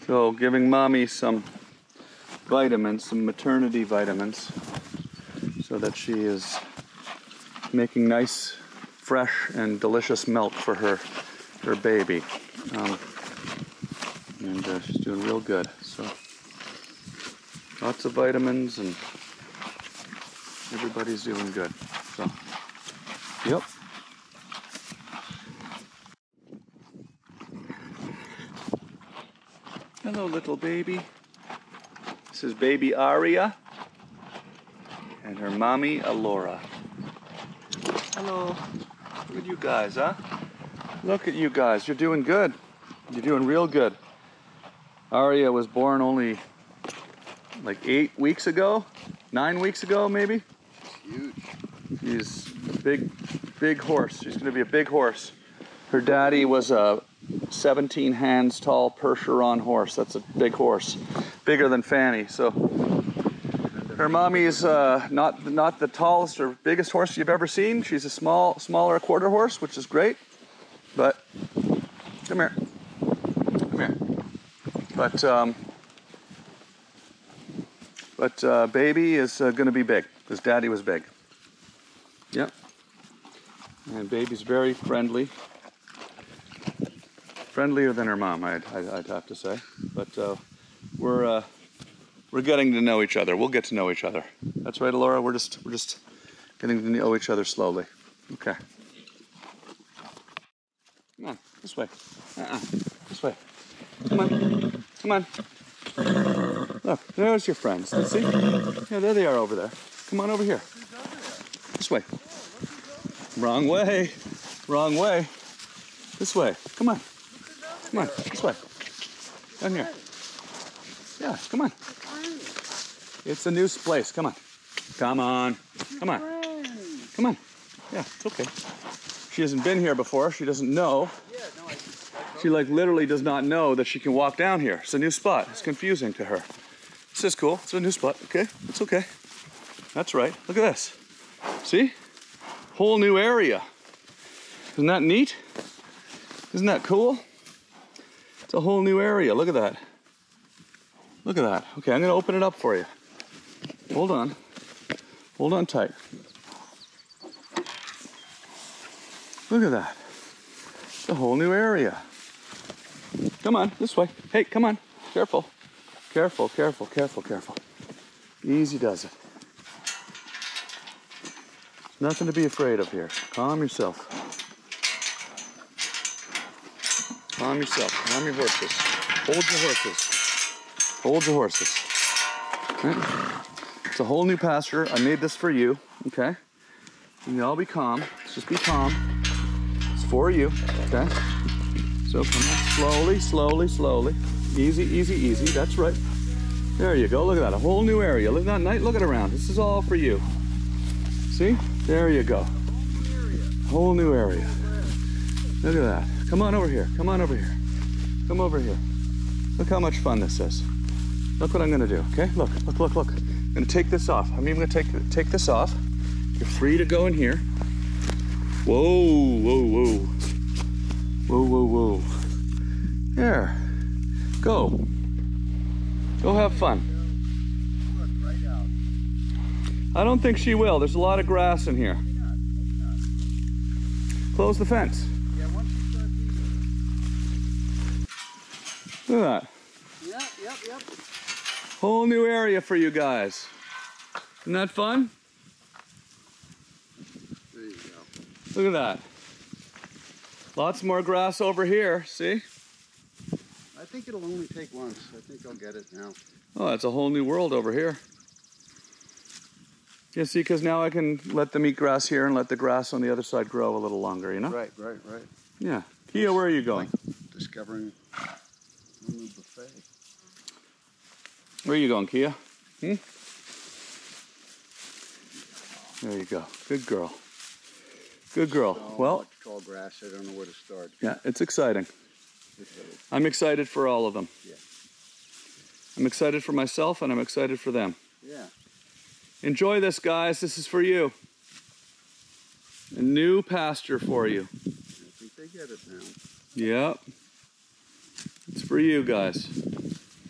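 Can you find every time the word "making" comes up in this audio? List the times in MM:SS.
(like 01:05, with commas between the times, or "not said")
00:07.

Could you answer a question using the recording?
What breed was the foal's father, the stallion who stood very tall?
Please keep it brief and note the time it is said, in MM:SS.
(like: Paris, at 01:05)
Percheron, at 00:58.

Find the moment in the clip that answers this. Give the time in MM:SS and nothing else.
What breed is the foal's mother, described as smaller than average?
01:08.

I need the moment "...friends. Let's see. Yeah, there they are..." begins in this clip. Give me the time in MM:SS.
01:47.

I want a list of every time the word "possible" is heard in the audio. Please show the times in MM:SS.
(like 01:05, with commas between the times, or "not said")
not said.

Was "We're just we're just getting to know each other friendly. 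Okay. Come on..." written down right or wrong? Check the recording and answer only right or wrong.
wrong.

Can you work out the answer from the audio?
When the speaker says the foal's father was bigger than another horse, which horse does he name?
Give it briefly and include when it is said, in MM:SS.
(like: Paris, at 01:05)
Fanny, at 01:01.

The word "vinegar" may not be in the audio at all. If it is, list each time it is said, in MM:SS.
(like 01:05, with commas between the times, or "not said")
not said.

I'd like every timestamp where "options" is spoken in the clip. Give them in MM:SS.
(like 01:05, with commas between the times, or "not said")
not said.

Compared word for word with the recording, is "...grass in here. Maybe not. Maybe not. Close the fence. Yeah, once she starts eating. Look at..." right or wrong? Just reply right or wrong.
right.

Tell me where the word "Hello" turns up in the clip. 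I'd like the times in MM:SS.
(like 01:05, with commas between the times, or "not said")
00:30, 00:38.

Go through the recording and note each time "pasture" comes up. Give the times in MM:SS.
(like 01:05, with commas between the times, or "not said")
03:04, 04:53.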